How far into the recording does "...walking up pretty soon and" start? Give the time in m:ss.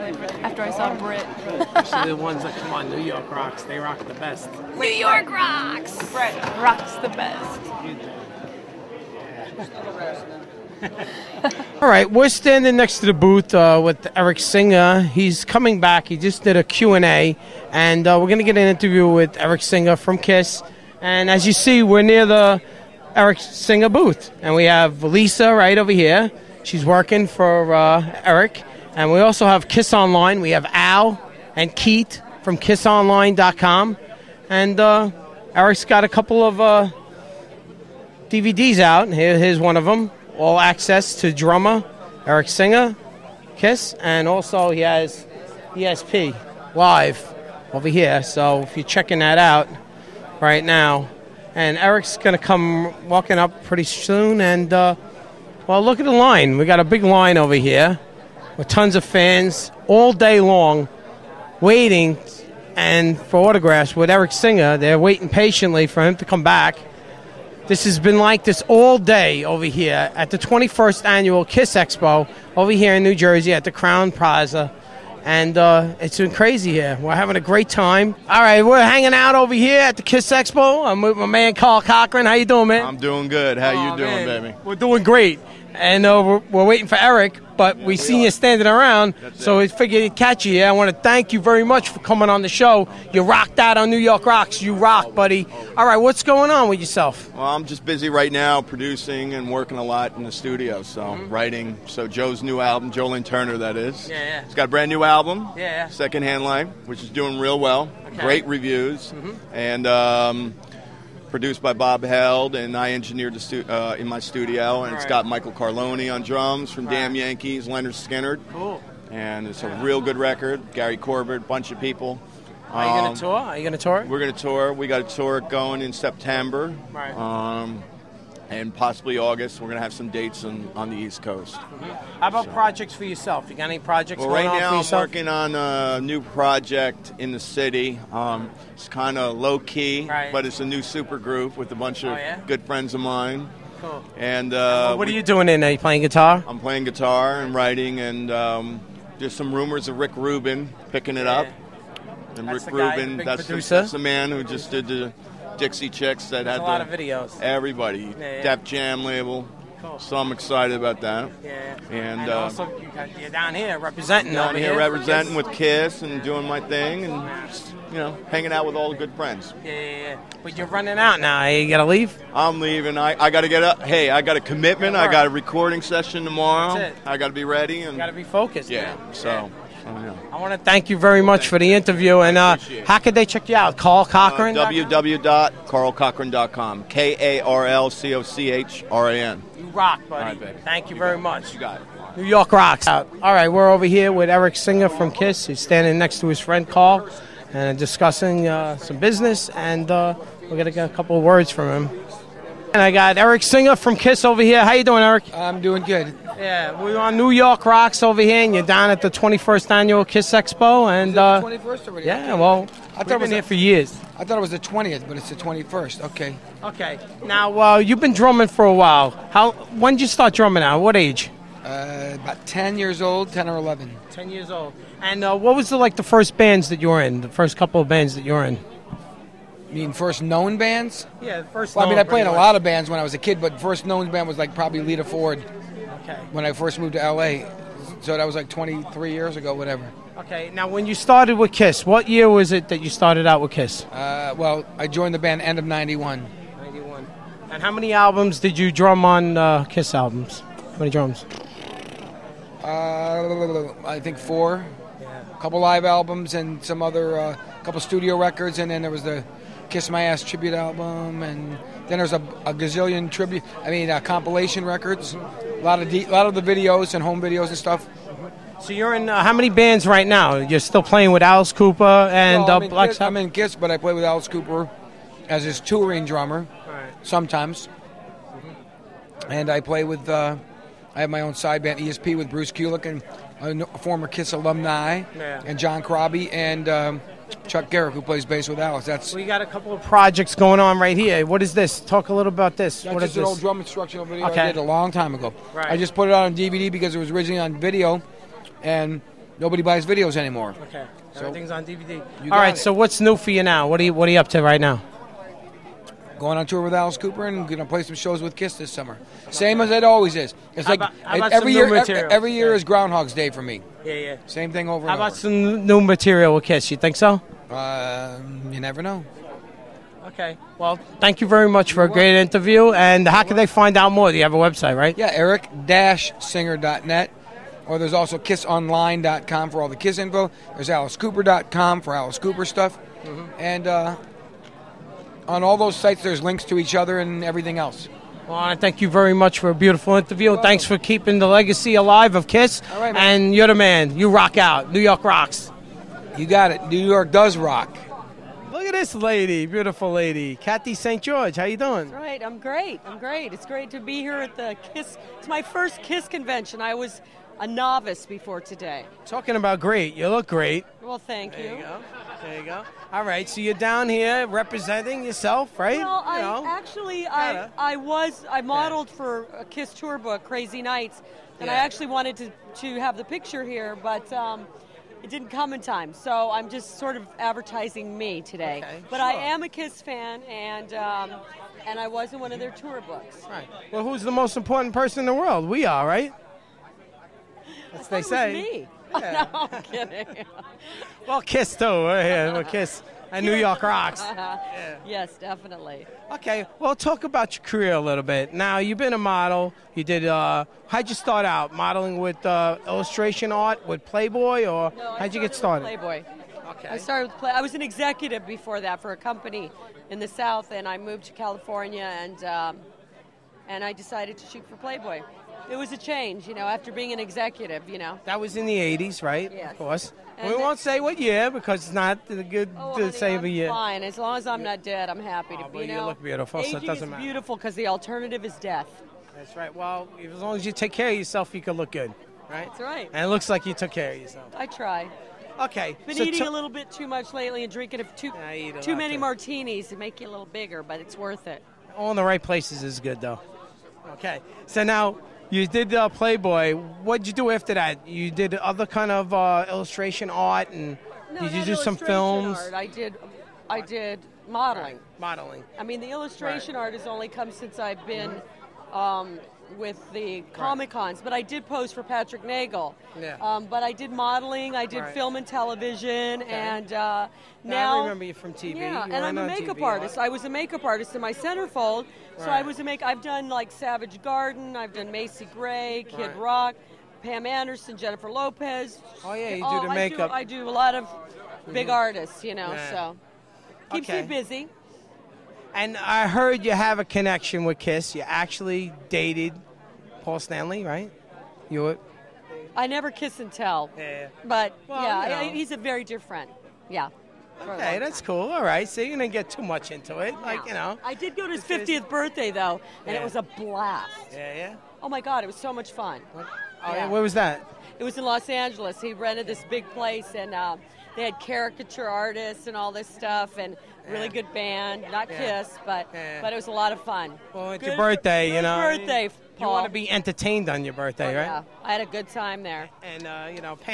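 0:53.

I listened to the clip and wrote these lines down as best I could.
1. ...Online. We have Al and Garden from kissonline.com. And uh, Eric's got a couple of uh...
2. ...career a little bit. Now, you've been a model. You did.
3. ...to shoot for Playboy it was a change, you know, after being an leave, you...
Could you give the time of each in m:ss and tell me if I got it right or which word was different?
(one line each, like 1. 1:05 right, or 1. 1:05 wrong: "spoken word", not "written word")
1. 0:29 wrong: "Keith", not "Garden"
2. 6:37 right
3. 6:54 wrong: "executive", not "leave".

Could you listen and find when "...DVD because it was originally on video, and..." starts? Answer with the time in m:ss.
4:56.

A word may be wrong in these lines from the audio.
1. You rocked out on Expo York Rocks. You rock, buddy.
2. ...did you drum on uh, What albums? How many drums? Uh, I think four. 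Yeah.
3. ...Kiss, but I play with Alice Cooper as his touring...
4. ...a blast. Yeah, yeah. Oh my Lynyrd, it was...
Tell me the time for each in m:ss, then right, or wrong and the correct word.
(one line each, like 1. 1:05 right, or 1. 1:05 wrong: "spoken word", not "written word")
1. 1:33 wrong: "New", not "Expo"
2. 4:08 wrong: "Kiss", not "What"
3. 4:33 right
4. 8:23 wrong: "God", not "Lynyrd".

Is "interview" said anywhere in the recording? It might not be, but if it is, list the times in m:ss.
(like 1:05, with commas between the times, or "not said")
0:18, 3:01, 5:22, 5:39.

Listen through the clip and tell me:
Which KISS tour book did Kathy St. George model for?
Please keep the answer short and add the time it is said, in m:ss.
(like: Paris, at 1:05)
Crazy Nights, at 6:10.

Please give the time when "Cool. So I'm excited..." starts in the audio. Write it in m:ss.
2:39.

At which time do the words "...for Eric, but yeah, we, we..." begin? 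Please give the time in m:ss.
1:26.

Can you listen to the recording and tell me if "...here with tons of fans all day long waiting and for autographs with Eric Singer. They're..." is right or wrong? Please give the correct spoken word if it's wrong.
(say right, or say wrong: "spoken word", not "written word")
right.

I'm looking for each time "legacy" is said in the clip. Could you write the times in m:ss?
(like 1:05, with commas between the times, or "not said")
5:41.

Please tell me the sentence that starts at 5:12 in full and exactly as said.
Every, year is Groundhog's Day for me.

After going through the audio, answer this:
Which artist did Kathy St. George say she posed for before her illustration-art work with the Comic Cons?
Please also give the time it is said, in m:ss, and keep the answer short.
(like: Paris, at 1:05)
Patrick Nagel, at 7:41.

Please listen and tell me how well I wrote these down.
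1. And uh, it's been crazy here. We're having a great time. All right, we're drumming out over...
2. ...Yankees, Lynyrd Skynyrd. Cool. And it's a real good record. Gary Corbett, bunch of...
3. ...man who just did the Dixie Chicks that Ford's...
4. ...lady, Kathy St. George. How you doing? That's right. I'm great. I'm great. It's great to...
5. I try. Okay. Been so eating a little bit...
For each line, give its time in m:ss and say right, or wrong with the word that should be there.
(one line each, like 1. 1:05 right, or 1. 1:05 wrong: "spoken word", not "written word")
1. 1:15 wrong: "hanging", not "drumming"
2. 1:57 right
3. 2:33 wrong: "That", not "Ford"
4. 5:49 right
5. 7:14 right.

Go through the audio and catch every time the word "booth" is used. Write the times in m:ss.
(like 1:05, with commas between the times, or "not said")
0:13, 0:23.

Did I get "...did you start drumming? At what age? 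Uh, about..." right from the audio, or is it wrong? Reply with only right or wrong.
right.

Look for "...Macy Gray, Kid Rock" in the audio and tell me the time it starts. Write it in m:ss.
7:54.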